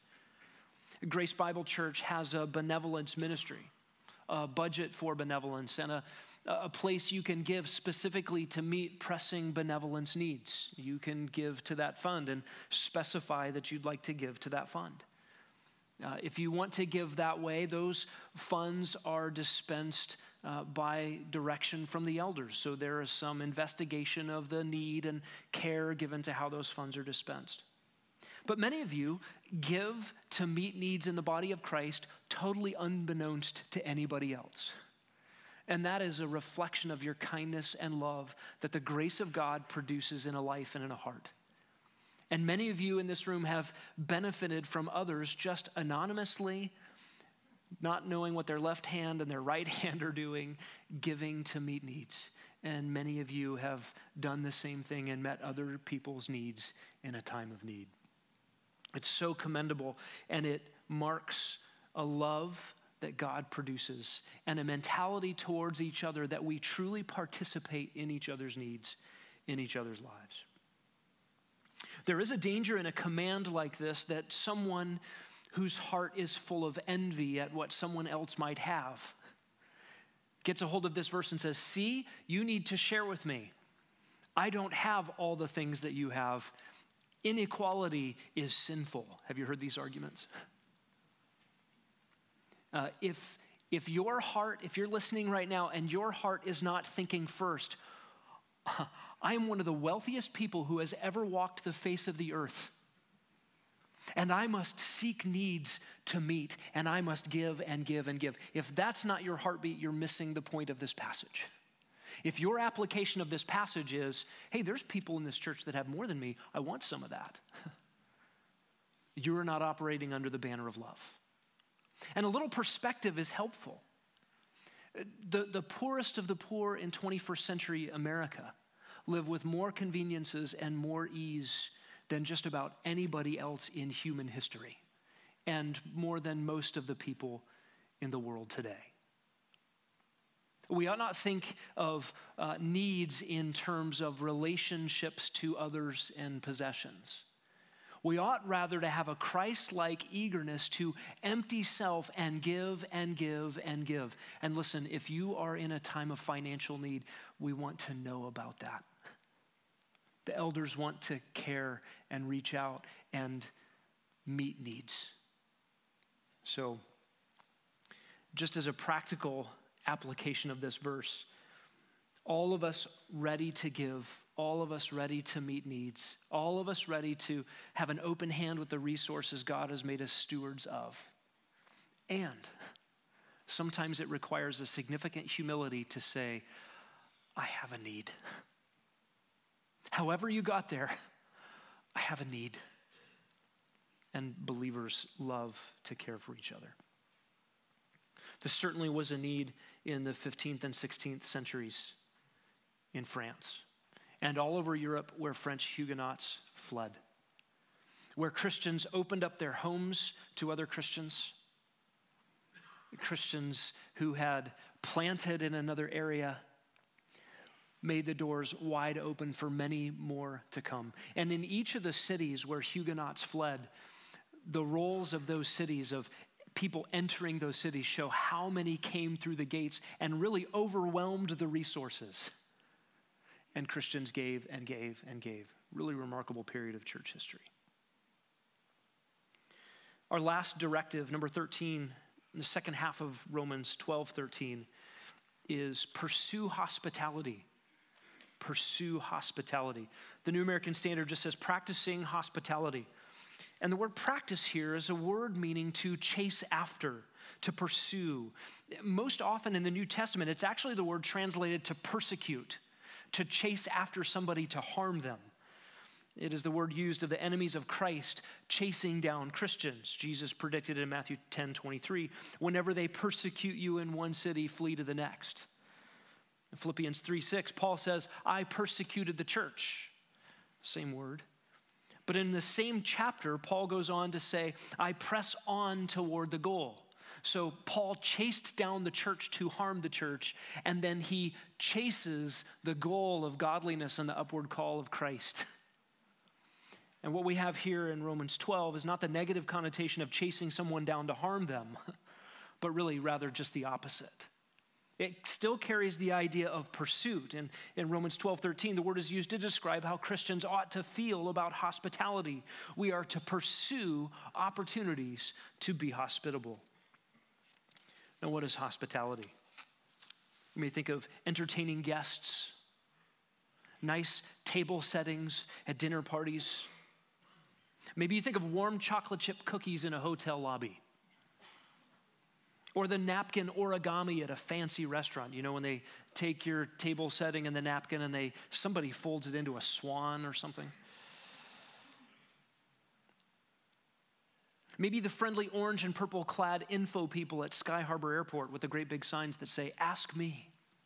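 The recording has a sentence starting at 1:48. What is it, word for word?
If that's not your heartbeat, you're missing the point of this passage.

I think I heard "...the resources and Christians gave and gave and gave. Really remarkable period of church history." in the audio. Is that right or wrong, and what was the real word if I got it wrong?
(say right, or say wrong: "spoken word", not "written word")
right.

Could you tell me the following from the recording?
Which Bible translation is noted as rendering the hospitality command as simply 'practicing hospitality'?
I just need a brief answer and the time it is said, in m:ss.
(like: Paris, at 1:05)
New American Standard, at 4:10.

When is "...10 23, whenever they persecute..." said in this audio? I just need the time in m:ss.
4:31.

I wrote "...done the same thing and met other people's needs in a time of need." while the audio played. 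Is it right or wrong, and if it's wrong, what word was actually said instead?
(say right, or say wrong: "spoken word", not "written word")
right.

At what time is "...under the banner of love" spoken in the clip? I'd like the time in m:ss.
2:00.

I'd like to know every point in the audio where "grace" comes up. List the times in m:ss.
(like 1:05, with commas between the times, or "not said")
0:01, 0:38.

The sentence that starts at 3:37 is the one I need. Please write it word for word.
Made the doors wide open for many more to come.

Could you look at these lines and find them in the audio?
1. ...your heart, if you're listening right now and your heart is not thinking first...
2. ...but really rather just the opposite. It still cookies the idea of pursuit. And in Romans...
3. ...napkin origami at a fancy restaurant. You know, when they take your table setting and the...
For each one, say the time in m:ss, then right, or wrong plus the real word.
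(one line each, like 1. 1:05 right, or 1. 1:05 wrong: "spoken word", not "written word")
1. 1:33 right
2. 5:02 wrong: "carries", not "cookies"
3. 5:32 right.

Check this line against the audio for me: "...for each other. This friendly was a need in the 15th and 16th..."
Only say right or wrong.
wrong.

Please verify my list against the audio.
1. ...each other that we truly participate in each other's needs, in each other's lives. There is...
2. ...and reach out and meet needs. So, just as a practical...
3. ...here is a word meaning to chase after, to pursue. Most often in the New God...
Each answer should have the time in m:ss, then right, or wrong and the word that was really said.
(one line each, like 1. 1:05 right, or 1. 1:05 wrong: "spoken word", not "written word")
1. 1:05 right
2. 2:42 right
3. 4:14 wrong: "Testament", not "God".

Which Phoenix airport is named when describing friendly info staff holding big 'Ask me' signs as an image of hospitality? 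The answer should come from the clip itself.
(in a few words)
Sky Harbor Airport.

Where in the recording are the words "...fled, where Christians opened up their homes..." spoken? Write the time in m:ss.
3:26.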